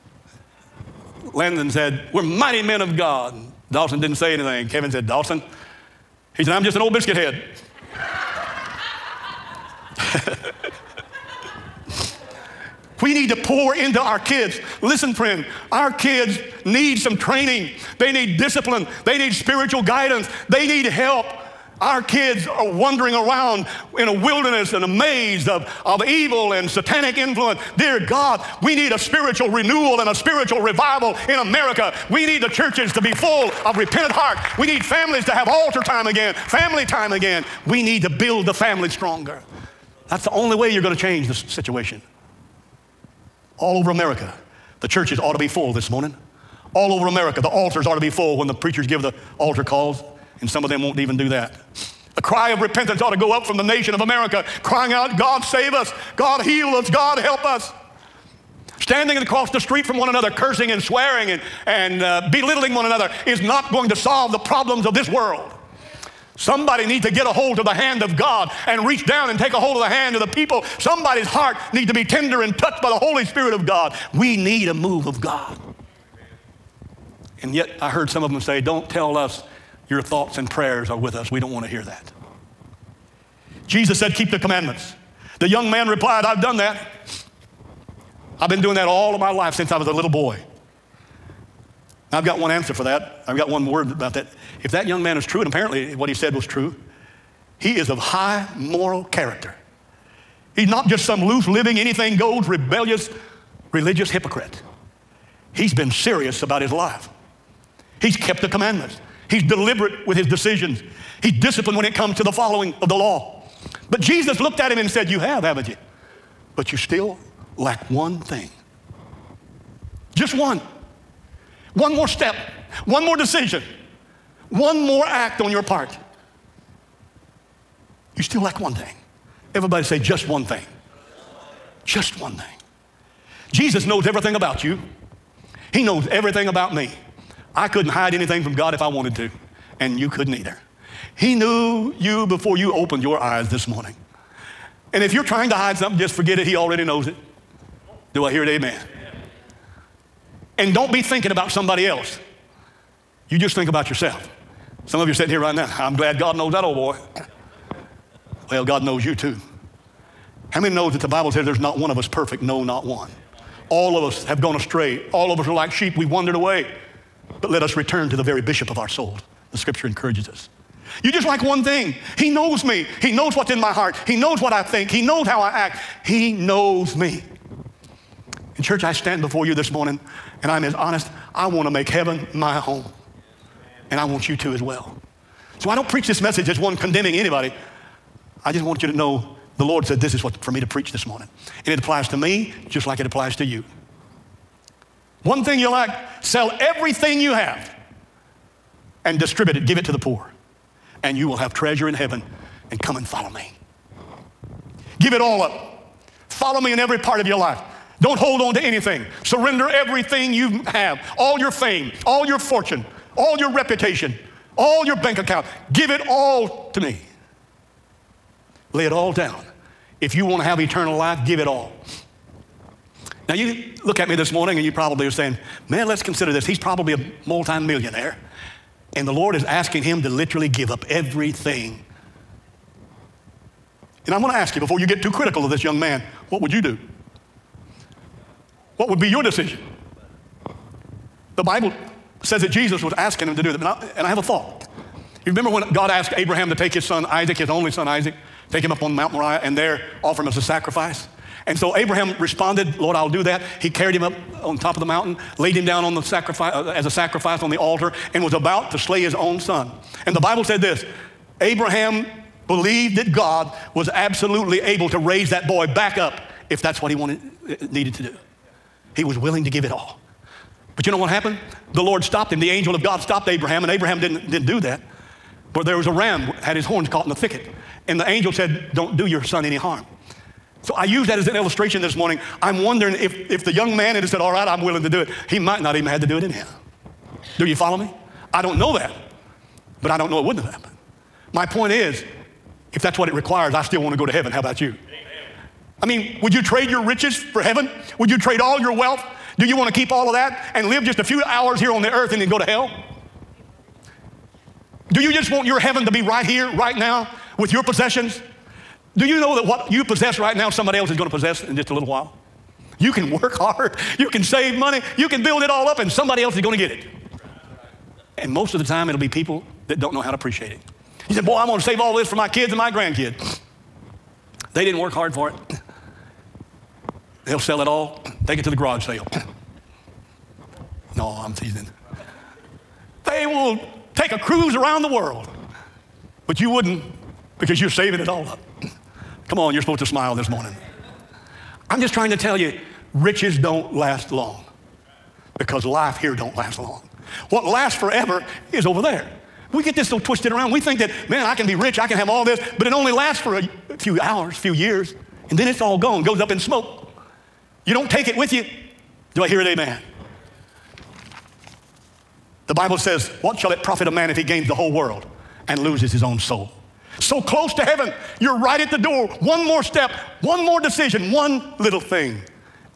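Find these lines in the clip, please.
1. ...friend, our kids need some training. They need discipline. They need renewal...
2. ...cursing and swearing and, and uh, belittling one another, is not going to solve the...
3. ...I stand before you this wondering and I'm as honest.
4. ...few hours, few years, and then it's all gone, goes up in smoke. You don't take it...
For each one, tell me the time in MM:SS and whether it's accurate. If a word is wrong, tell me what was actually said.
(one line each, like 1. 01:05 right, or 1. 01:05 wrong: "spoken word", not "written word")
1. 00:15 wrong: "spiritual", not "renewal"
2. 01:00 right
3. 02:58 wrong: "morning", not "wondering"
4. 05:53 right.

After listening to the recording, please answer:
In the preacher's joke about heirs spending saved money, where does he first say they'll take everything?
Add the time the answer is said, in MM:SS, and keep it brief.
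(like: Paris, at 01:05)
The garage sale, at 05:28.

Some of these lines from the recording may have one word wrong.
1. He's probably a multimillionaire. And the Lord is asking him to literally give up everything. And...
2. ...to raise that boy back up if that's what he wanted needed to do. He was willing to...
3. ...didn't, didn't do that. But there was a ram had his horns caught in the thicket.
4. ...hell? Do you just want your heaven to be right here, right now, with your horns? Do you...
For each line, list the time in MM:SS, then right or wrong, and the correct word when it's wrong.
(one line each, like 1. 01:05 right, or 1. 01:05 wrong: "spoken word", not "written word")
1. 03:46 right
2. 04:24 right
3. 04:33 right
4. 05:02 wrong: "possessions", not "horns".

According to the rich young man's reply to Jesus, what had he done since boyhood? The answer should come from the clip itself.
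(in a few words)
Keep the commandments.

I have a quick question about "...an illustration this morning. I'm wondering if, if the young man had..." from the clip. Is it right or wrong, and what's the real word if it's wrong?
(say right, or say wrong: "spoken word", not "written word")
right.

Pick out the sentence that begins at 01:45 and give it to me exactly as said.
He's been serious about his life.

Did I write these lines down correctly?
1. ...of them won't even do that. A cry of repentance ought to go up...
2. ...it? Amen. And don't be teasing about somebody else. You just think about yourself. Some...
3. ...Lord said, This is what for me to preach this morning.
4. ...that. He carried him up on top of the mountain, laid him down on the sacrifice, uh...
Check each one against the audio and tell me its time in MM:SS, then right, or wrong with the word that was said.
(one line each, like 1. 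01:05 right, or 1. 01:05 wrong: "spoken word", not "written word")
1. 00:50 right
2. 02:28 wrong: "thinking", not "teasing"
3. 03:09 right
4. 04:13 right.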